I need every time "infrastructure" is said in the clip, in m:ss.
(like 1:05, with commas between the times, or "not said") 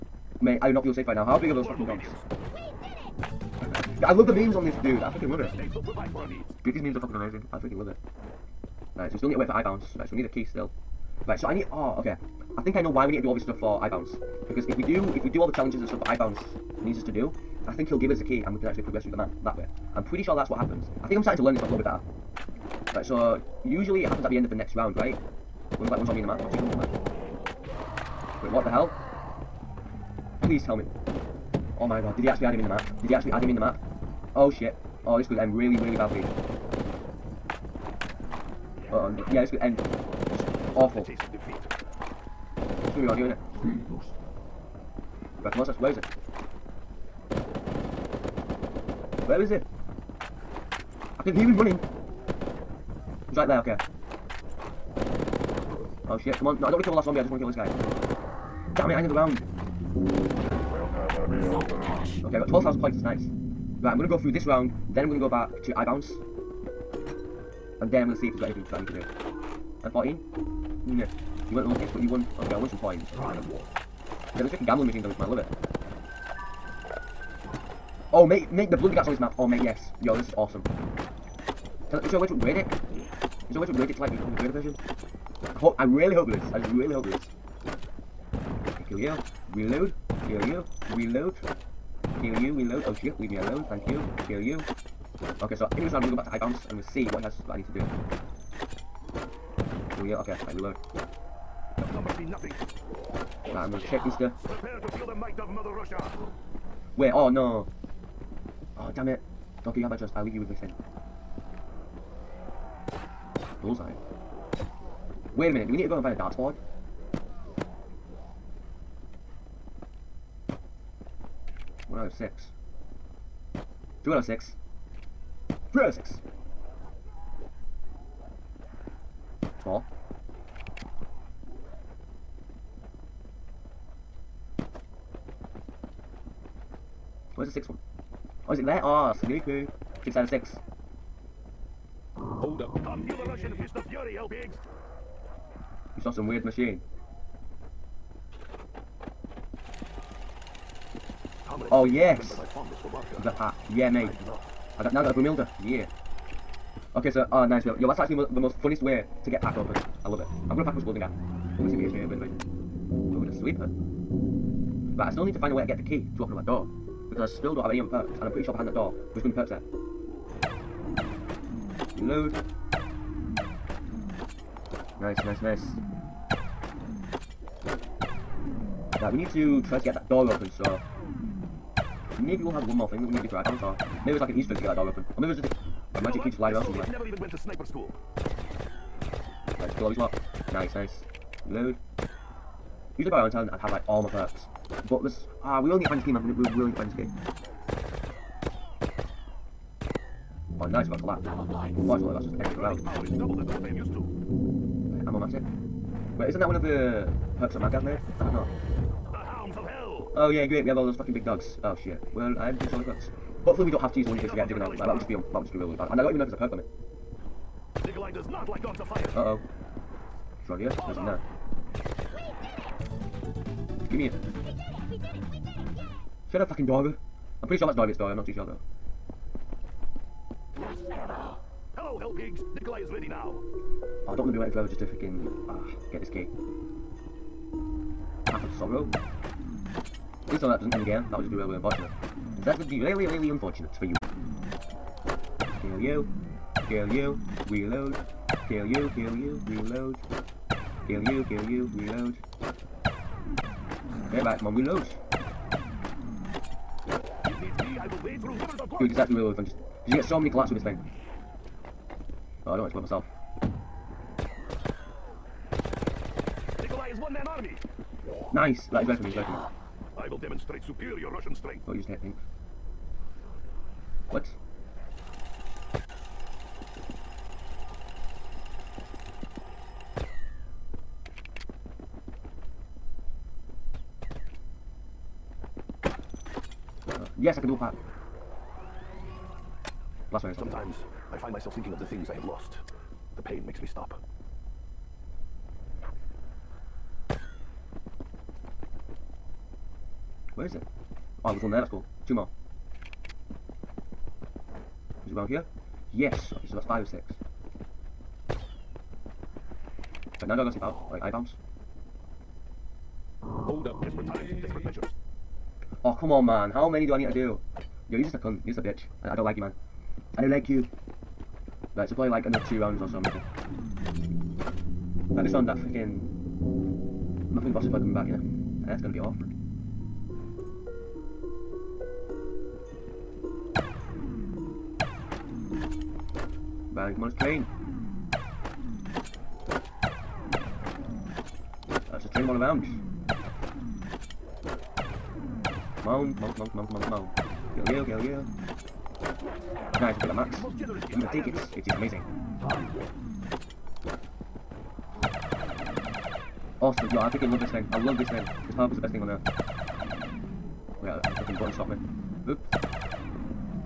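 not said.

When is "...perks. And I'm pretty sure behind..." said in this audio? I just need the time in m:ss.
2:47.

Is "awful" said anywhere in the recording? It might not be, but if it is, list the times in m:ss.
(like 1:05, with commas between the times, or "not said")
0:40, 5:28.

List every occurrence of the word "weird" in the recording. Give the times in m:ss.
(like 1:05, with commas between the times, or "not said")
2:26.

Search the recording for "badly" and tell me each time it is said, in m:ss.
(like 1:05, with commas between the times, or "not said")
0:35.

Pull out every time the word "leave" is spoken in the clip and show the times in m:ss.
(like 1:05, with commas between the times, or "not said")
1:33, 1:50.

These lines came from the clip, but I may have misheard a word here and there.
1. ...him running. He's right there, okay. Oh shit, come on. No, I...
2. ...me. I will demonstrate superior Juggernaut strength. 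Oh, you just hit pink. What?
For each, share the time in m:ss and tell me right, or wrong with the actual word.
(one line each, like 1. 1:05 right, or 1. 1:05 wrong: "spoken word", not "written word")
1. 0:51 right
2. 4:29 wrong: "Russian", not "Juggernaut".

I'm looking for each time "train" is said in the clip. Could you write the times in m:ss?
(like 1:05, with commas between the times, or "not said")
5:37, 5:42.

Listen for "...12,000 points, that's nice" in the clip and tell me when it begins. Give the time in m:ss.
1:02.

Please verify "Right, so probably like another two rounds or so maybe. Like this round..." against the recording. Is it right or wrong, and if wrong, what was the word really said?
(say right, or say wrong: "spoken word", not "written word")
right.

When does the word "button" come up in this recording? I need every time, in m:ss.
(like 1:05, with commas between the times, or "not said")
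6:01.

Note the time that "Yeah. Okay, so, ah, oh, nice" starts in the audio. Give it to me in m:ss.
2:35.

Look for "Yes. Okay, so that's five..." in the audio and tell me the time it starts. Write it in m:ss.
5:05.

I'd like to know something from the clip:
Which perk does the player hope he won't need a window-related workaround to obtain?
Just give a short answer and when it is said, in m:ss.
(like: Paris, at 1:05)
Juggernaut, at 3:34.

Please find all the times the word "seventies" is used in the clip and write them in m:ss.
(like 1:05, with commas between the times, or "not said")
not said.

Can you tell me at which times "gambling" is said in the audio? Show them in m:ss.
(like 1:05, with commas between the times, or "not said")
1:14.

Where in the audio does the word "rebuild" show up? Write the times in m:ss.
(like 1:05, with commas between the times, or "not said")
not said.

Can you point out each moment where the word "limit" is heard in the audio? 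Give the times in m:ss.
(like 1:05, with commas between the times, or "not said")
3:36.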